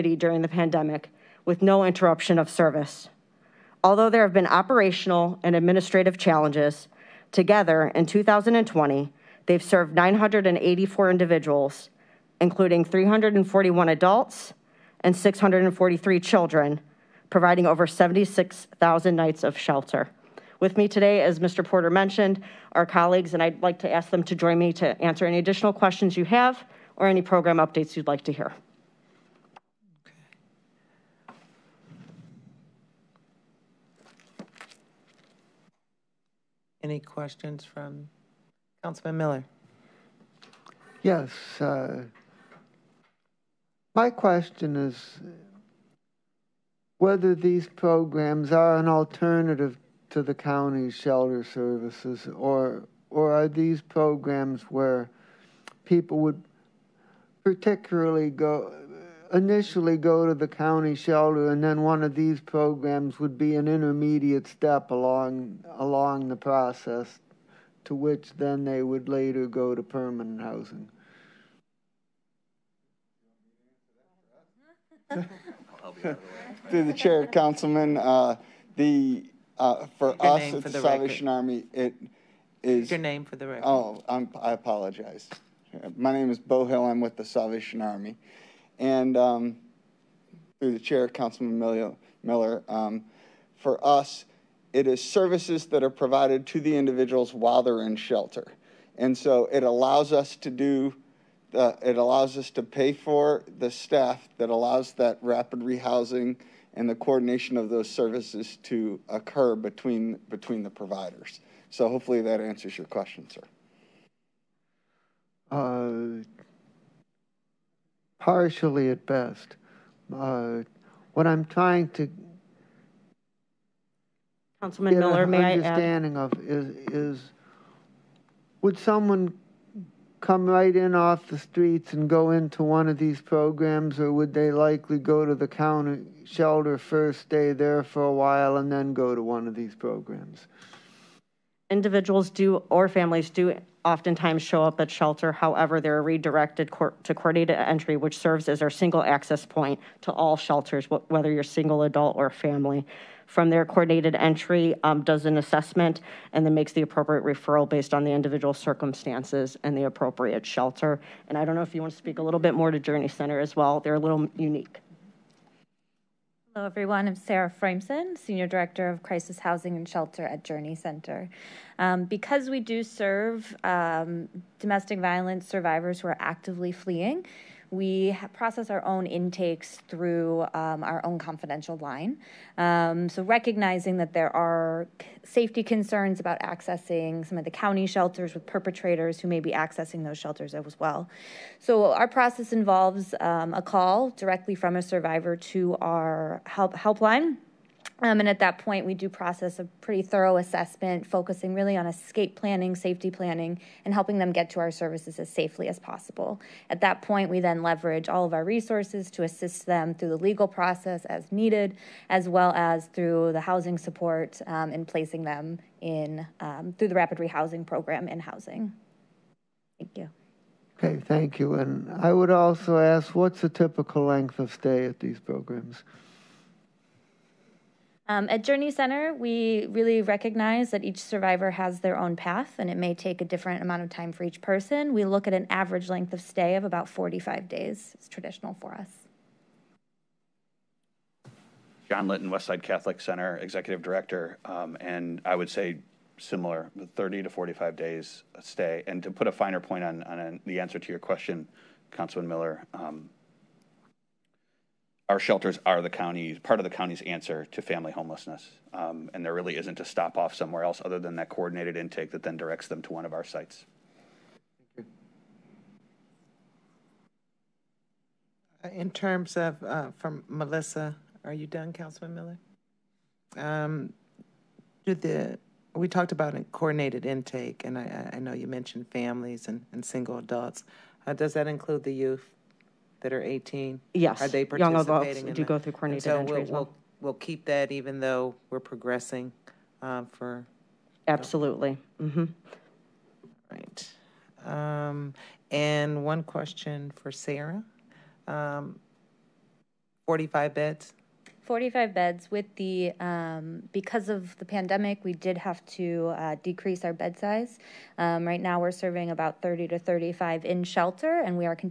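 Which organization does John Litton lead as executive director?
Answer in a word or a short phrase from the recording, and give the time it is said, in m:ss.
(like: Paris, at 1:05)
Westside Catholic Center, at 4:02.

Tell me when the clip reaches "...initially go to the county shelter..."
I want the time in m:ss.
0:59.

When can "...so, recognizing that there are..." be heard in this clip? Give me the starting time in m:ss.
3:03.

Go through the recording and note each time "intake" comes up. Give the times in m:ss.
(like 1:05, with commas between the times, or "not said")
2:59, 4:21, 4:37.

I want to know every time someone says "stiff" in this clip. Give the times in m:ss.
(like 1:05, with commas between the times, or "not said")
not said.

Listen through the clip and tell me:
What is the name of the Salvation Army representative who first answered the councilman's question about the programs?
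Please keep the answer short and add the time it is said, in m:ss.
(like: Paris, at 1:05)
Bo Hill, at 1:26.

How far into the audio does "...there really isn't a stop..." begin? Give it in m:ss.
4:19.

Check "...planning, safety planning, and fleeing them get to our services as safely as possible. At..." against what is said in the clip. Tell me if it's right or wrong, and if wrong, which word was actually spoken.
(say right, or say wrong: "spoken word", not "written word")
wrong: "helping", not "fleeing".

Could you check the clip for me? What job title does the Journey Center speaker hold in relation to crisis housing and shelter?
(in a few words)
Senior Director.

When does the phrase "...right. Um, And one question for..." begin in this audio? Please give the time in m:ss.
4:53.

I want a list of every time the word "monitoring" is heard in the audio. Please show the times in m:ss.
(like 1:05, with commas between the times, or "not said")
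not said.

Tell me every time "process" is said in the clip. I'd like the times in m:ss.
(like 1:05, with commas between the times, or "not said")
1:06, 2:58, 3:12, 3:19, 3:30.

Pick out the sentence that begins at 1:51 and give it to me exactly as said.
So hopefully that answers your question, sir.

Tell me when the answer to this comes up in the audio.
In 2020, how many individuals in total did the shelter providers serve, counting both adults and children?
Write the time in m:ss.
0:09.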